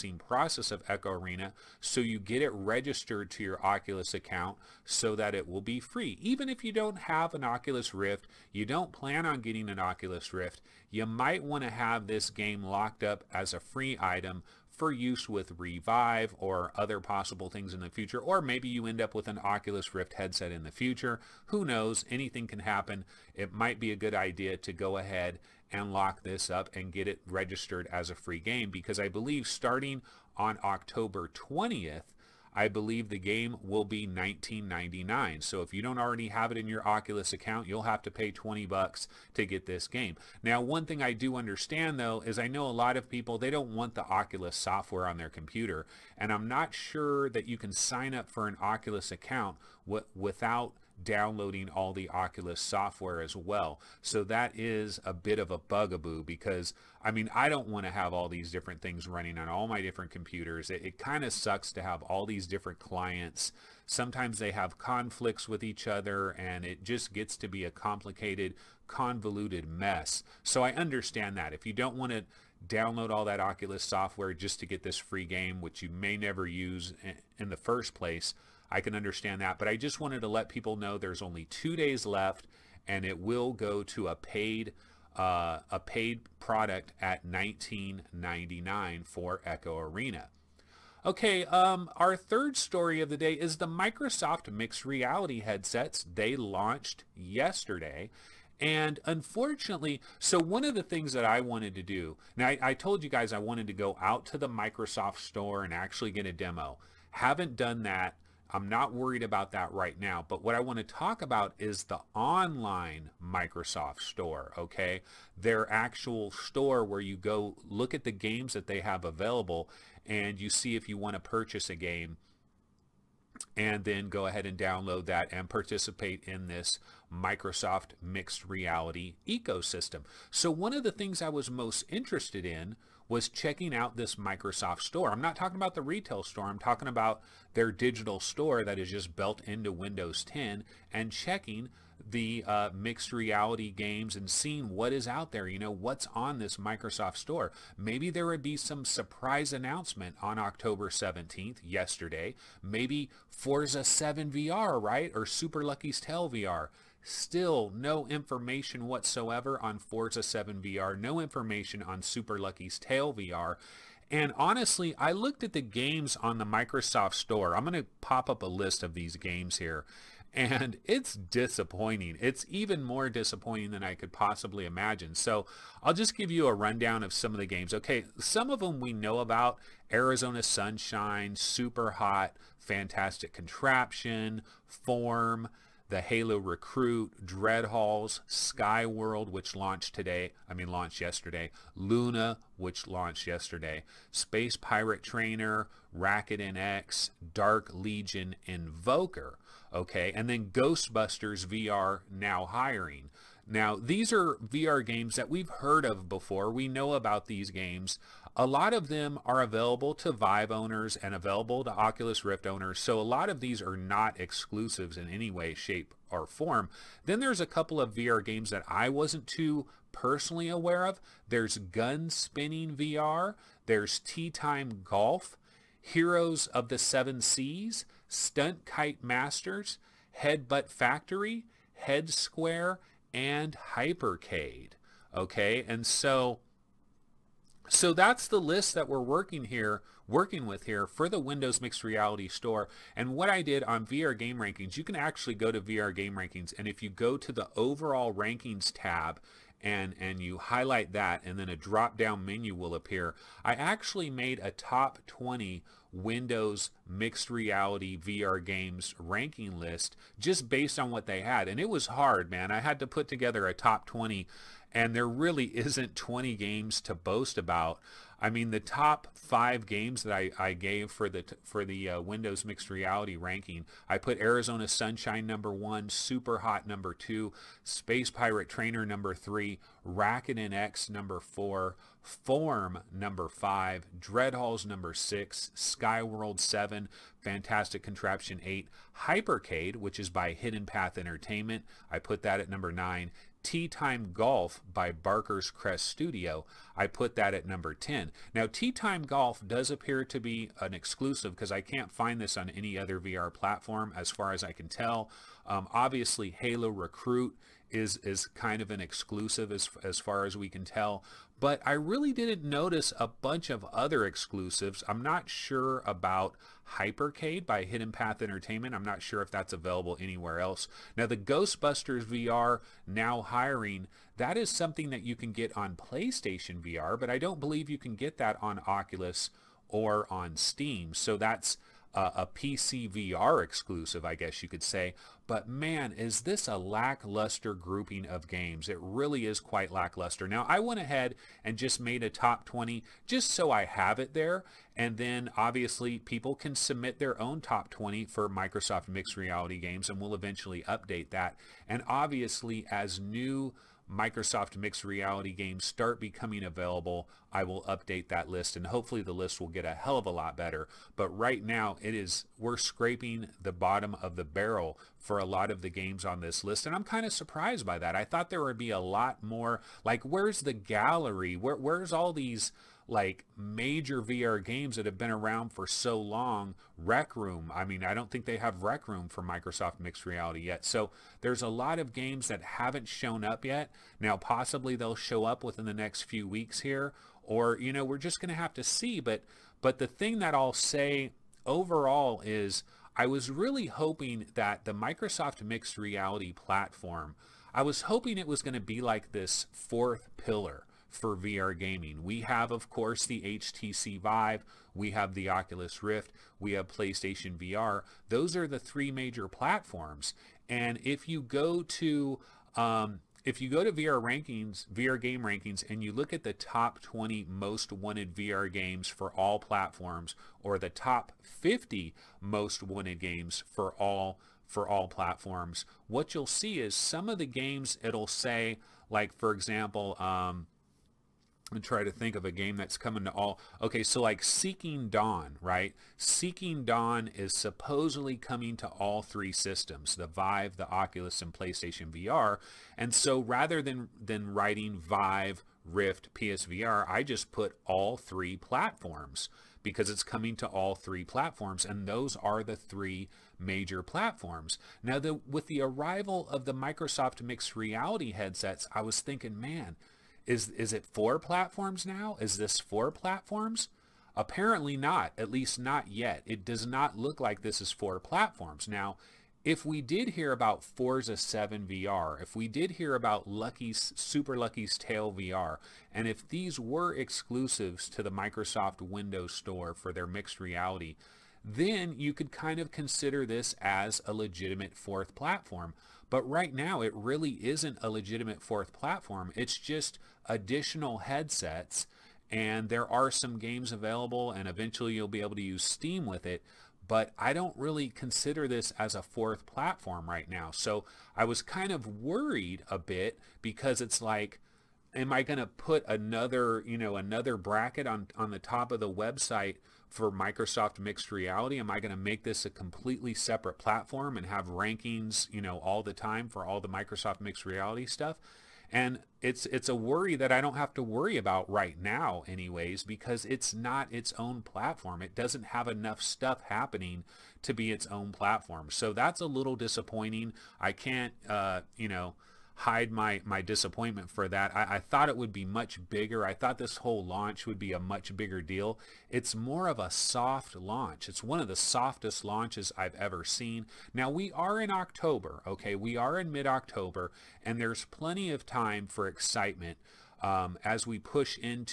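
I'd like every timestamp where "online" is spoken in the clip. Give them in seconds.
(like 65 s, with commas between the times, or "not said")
112 s.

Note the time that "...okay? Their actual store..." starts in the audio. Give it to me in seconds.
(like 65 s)
114 s.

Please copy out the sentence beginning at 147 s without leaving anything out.
Maybe there would be some surprise announcement on October 17th, yesterday.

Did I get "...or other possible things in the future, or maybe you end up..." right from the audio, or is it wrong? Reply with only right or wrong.
right.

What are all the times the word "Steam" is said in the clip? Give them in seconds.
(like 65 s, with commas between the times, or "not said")
330 s, 495 s.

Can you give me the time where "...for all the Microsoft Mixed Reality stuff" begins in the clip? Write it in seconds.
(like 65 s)
516 s.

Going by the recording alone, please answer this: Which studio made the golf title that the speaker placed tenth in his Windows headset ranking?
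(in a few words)
Barker's Crest Studio.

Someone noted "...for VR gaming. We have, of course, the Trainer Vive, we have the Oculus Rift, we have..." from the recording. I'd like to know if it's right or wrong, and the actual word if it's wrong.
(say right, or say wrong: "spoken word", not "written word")
wrong: "HTC", not "Trainer".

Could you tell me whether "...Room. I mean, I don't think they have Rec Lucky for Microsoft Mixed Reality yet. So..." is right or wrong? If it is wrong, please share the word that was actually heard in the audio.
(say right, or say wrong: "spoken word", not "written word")
wrong: "Room", not "Lucky".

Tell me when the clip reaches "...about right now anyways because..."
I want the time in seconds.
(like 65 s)
521 s.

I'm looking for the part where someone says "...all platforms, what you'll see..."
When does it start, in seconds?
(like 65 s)
424 s.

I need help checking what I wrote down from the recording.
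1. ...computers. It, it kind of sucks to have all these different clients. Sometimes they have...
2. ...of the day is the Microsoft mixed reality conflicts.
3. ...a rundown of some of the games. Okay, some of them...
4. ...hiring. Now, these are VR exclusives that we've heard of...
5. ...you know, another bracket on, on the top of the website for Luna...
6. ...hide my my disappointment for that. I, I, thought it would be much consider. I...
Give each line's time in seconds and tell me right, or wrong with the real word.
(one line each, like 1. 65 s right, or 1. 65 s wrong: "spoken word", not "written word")
1. 60 s right
2. 93 s wrong: "headsets", not "conflicts"
3. 176 s right
4. 202 s wrong: "games", not "exclusives"
5. 506 s wrong: "Microsoft", not "Luna"
6. 532 s wrong: "bigger", not "consider".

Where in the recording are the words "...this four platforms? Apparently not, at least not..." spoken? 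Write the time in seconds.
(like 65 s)
462 s.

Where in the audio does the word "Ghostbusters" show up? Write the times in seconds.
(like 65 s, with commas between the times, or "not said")
200 s, 321 s.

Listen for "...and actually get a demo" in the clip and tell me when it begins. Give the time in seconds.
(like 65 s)
105 s.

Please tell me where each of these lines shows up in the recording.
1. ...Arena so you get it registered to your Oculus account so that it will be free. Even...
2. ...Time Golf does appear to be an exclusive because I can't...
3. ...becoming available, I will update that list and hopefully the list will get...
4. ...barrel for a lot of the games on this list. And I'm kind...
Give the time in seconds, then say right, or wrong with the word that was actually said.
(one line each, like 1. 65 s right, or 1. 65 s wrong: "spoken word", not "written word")
1. 1 s right
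2. 298 s right
3. 356 s right
4. 364 s right.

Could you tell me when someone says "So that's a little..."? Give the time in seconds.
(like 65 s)
528 s.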